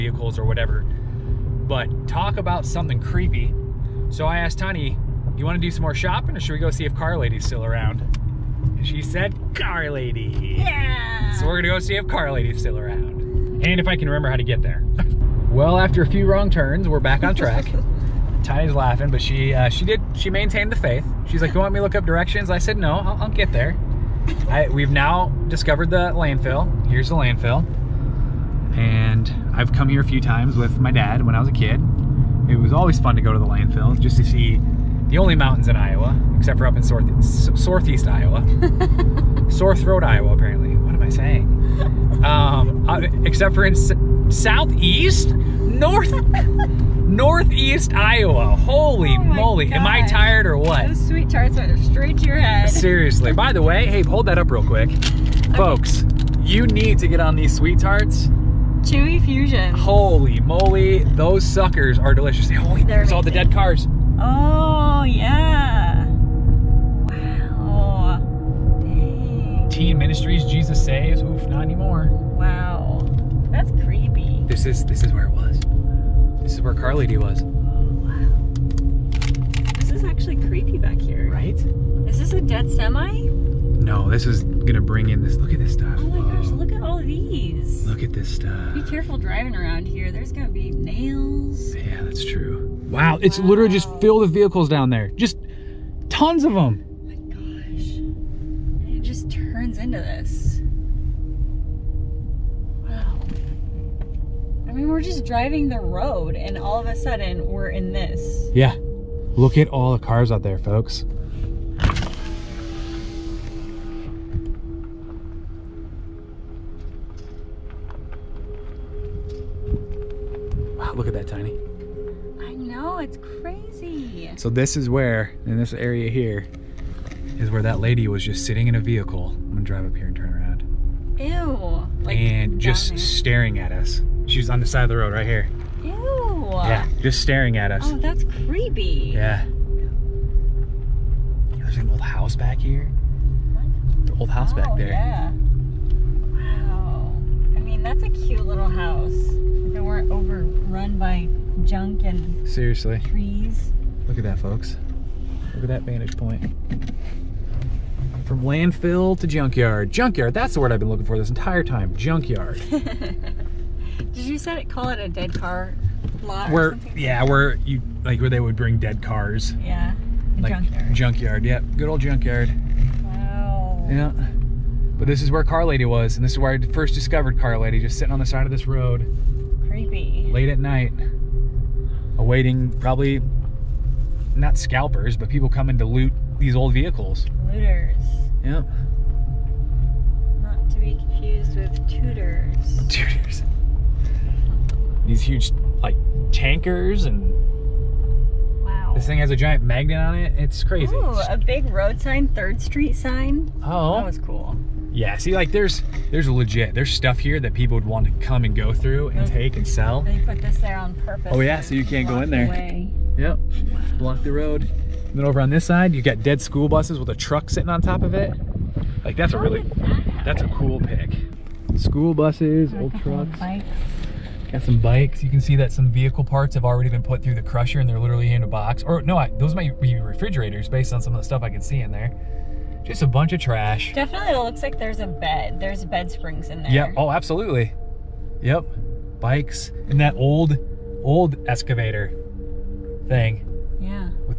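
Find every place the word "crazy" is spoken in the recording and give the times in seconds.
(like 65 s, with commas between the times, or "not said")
123 s, 200 s.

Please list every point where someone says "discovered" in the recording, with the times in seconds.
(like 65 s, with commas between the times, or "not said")
25 s, 176 s.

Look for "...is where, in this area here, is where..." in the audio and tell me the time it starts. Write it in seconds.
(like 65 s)
124 s.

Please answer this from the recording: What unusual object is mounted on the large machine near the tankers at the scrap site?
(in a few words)
A giant magnet.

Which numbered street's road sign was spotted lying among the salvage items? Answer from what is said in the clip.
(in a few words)
Third Street.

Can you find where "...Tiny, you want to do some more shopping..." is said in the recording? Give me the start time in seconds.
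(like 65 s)
4 s.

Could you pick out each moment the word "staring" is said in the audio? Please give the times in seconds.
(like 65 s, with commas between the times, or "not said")
132 s, 137 s.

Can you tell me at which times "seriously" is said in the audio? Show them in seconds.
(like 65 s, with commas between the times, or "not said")
52 s, 152 s.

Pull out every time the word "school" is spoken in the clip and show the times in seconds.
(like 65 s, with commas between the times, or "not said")
216 s, 221 s.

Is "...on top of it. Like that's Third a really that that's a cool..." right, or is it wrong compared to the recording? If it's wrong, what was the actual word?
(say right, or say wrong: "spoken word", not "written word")
wrong: "How", not "Third".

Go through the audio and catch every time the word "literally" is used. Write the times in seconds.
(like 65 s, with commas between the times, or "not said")
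93 s, 227 s.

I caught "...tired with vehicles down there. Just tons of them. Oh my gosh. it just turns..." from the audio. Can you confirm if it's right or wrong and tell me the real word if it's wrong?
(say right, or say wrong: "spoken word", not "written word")
wrong: "filled", not "tired".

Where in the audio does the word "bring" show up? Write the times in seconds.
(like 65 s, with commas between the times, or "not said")
84 s, 168 s.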